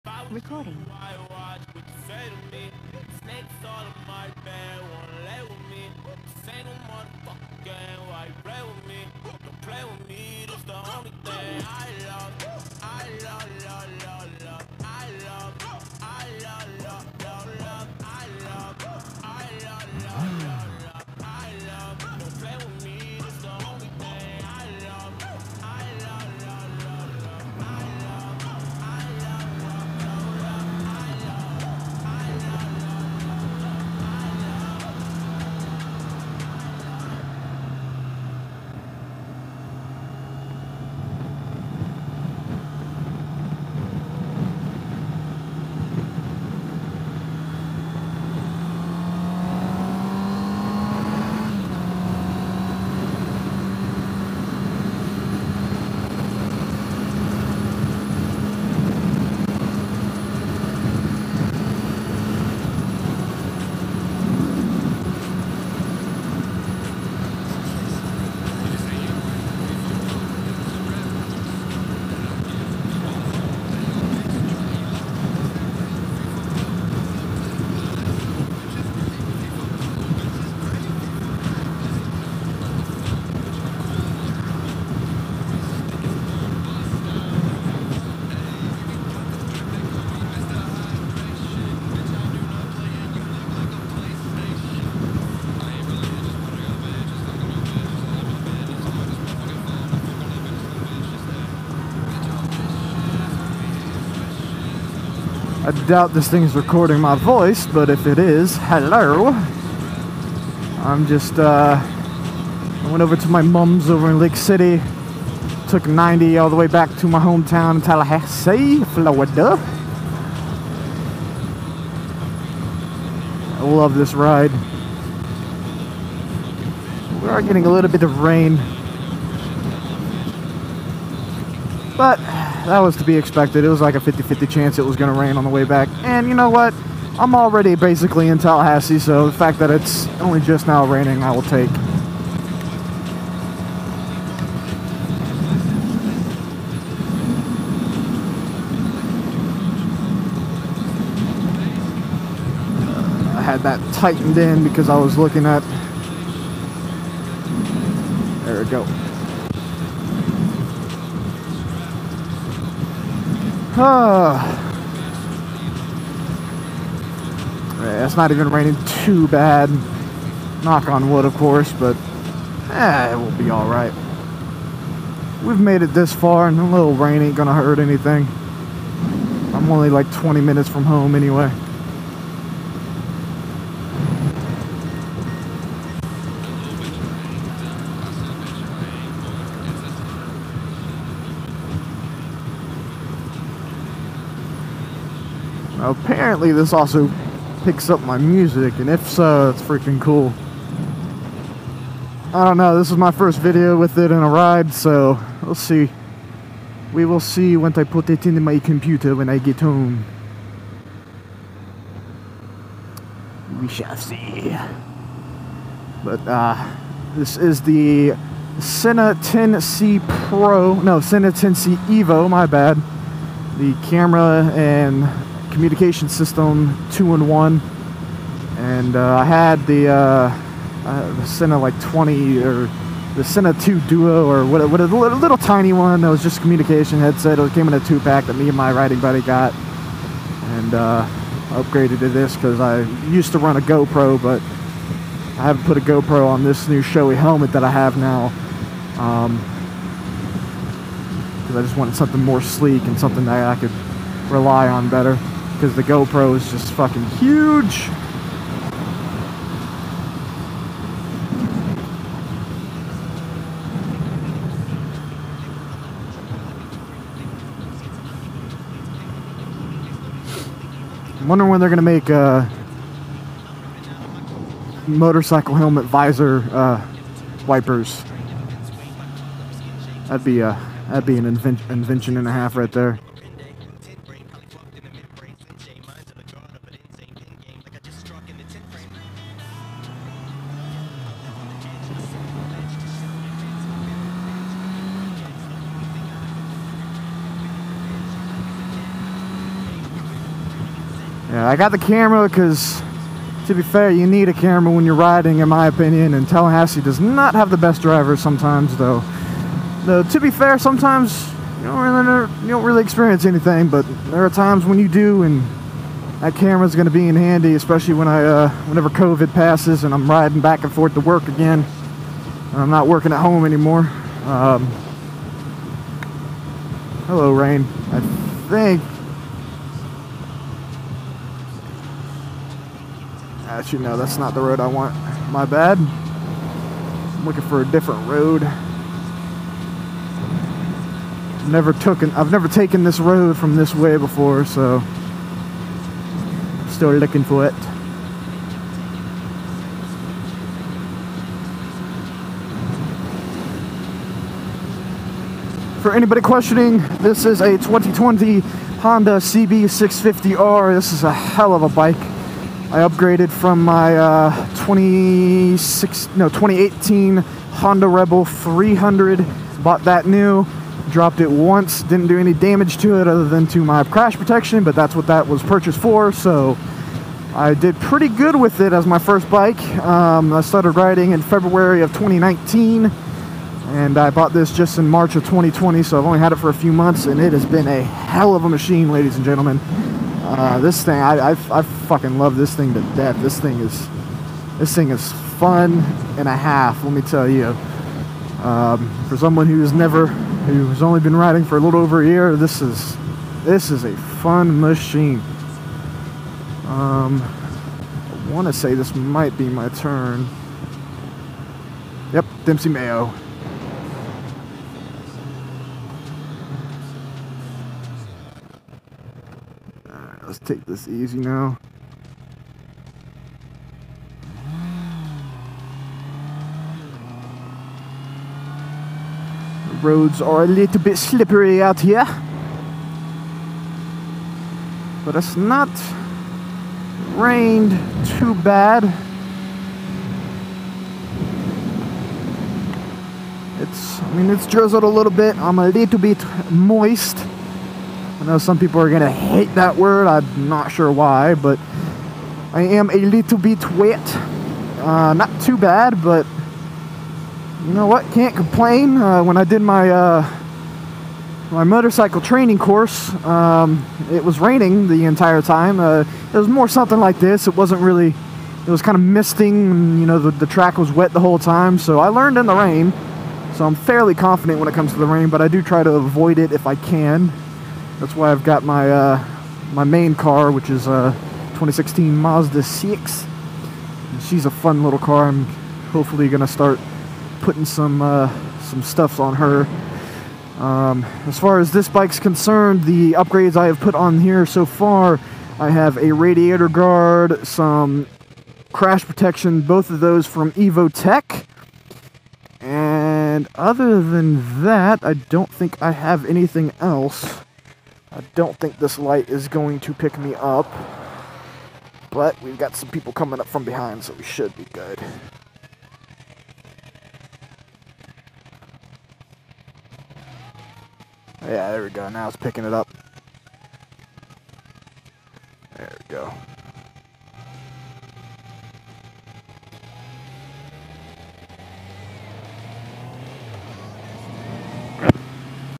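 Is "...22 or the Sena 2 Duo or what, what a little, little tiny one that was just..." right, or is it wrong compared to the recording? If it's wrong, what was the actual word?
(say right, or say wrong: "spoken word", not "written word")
wrong: "20", not "22".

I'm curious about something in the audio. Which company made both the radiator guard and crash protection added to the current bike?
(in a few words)
Evotech.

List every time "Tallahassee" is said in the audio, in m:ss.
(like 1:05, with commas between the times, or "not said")
1:57, 2:18, 5:06.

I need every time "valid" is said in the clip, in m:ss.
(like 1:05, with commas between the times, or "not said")
not said.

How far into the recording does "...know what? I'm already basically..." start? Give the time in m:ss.
2:16.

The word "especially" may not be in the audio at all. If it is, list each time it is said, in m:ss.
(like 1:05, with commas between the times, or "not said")
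5:17.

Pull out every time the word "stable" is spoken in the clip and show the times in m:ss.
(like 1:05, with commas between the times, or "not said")
not said.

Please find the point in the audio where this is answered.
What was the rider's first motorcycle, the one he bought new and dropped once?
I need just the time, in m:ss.
6:06.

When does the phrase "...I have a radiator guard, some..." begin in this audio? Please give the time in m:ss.
8:15.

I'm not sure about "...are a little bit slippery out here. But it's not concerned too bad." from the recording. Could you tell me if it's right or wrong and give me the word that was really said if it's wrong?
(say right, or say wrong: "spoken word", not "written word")
wrong: "rained", not "concerned".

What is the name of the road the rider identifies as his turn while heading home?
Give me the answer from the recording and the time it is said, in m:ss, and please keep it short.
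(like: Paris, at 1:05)
Dempsey Mayo, at 6:52.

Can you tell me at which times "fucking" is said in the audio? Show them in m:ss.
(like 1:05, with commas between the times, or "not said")
4:16, 6:31.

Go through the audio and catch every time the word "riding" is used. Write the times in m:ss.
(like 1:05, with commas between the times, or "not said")
3:58, 5:04, 5:20, 6:20, 6:41.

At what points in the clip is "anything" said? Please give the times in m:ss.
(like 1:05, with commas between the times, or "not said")
2:57, 5:13, 8:26.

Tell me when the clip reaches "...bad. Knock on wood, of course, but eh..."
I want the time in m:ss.
2:49.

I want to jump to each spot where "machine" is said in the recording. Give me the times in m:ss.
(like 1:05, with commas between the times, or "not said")
6:28, 6:44.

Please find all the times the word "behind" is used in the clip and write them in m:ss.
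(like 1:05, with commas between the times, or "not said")
8:33.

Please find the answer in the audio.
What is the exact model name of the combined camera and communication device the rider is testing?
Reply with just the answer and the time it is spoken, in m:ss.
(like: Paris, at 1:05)
Sena 10C Evo, at 3:40.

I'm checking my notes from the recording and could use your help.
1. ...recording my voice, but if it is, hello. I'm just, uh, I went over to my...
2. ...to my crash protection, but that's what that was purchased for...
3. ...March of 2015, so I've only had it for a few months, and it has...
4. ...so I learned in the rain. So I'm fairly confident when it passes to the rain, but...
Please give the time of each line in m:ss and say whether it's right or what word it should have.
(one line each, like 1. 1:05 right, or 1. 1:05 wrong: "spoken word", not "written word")
1. 1:46 right
2. 6:13 right
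3. 6:24 wrong: "2020", not "2015"
4. 7:51 wrong: "comes", not "passes".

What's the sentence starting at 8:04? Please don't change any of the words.
And she's a fun little car.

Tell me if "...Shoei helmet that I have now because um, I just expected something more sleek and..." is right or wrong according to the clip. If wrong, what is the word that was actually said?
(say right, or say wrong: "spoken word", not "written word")
wrong: "wanted", not "expected".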